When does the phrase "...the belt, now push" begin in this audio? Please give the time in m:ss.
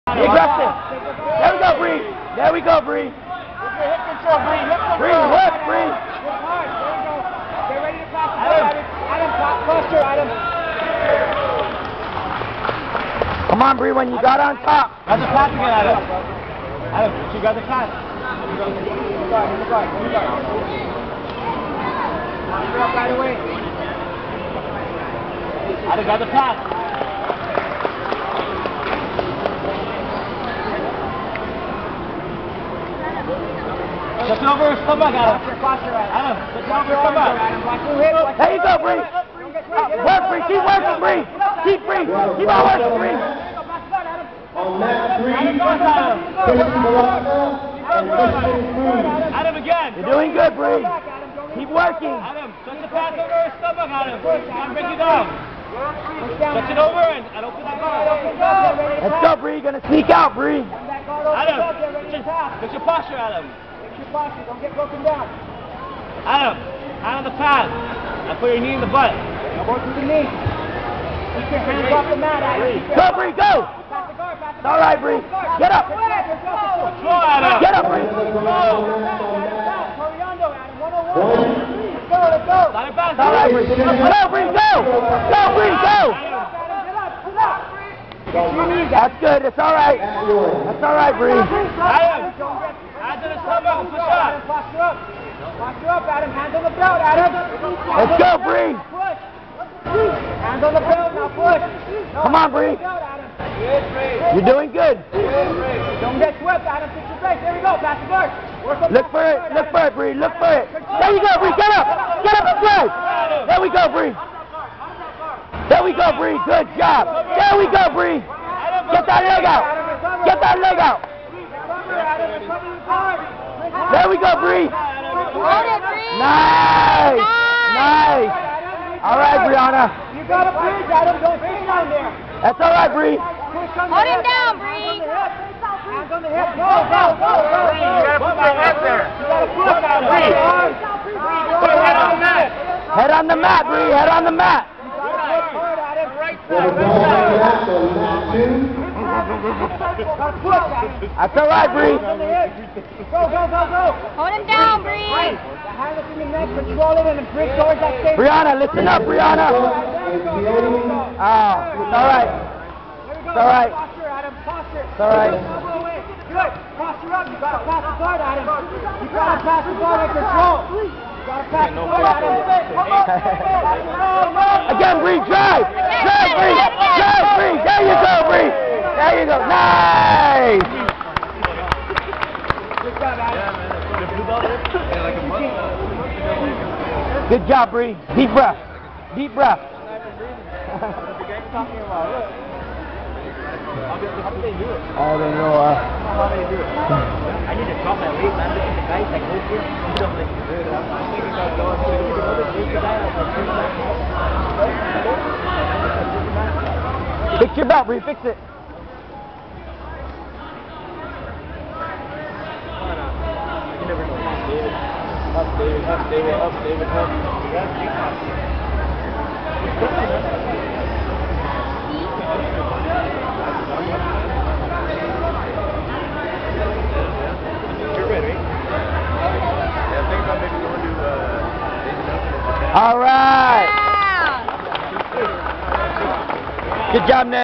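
1:40.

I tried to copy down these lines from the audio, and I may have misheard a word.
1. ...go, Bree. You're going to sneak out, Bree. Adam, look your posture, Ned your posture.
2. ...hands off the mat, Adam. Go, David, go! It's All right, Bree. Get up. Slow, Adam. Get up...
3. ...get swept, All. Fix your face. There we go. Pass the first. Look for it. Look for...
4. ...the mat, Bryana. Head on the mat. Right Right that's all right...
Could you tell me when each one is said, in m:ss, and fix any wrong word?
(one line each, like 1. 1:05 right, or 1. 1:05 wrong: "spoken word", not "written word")
1. 0:59 wrong: "Adam", not "Ned"
2. 1:11 wrong: "Bree", not "David"
3. 1:46 wrong: "Adam", not "All"
4. 2:23 wrong: "Bree", not "Bryana".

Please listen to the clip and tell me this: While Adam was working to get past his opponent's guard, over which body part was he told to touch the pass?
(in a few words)
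his stomach.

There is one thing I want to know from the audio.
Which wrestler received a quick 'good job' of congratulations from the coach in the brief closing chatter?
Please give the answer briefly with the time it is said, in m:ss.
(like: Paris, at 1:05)
Ned, at 3:57.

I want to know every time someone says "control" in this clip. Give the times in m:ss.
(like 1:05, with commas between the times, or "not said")
2:36, 2:50.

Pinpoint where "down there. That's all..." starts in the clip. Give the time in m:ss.
2:11.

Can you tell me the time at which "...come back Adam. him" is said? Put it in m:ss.
0:34.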